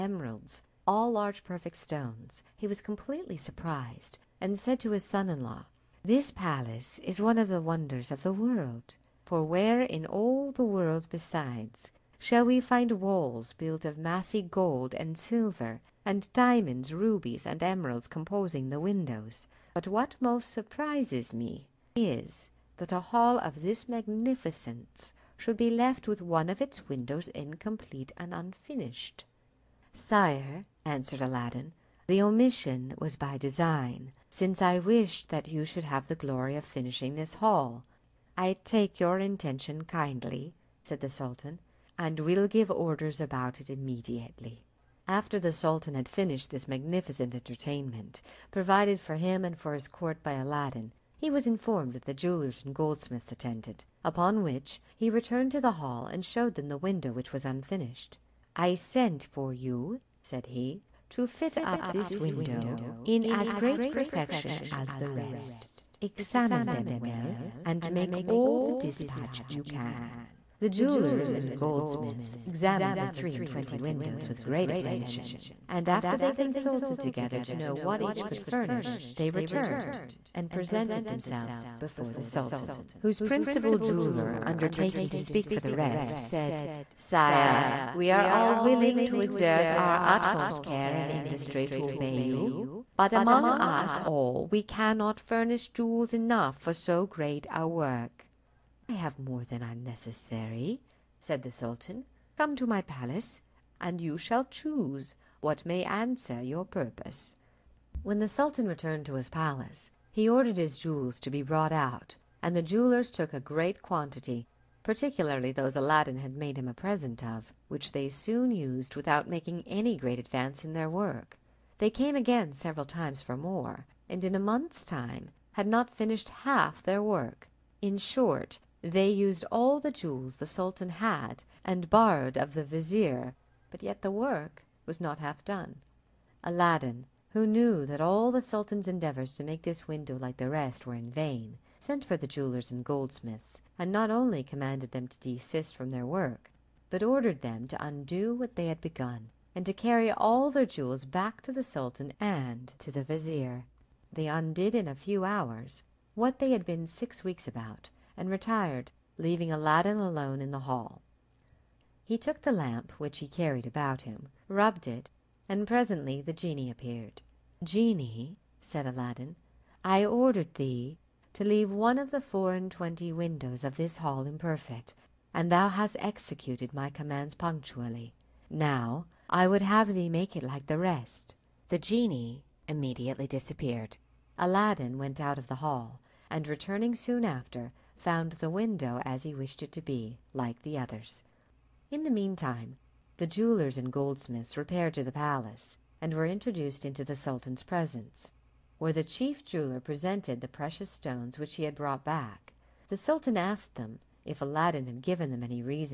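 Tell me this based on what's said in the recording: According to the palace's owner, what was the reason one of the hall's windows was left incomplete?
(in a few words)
By design.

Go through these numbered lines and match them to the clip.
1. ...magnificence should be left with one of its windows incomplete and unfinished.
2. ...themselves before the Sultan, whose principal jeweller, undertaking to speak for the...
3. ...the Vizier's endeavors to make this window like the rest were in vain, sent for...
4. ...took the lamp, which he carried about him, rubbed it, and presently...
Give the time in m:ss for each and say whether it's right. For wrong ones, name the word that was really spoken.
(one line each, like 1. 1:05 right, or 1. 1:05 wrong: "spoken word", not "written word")
1. 0:23 right
2. 1:21 right
3. 2:18 wrong: "Sultan", not "Vizier"
4. 2:42 right.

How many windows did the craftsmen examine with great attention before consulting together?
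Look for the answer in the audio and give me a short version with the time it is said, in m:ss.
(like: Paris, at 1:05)
23, at 1:13.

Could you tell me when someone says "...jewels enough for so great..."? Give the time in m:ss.
1:35.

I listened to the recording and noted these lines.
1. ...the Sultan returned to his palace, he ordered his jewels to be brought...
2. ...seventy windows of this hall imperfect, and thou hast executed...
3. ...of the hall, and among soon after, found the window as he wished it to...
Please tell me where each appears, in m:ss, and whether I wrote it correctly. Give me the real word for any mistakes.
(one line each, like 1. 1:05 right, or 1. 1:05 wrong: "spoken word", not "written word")
1. 1:48 right
2. 2:52 wrong: "twenty", not "seventy"
3. 3:05 wrong: "returning", not "among".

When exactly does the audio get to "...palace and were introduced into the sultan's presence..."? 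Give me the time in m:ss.
3:15.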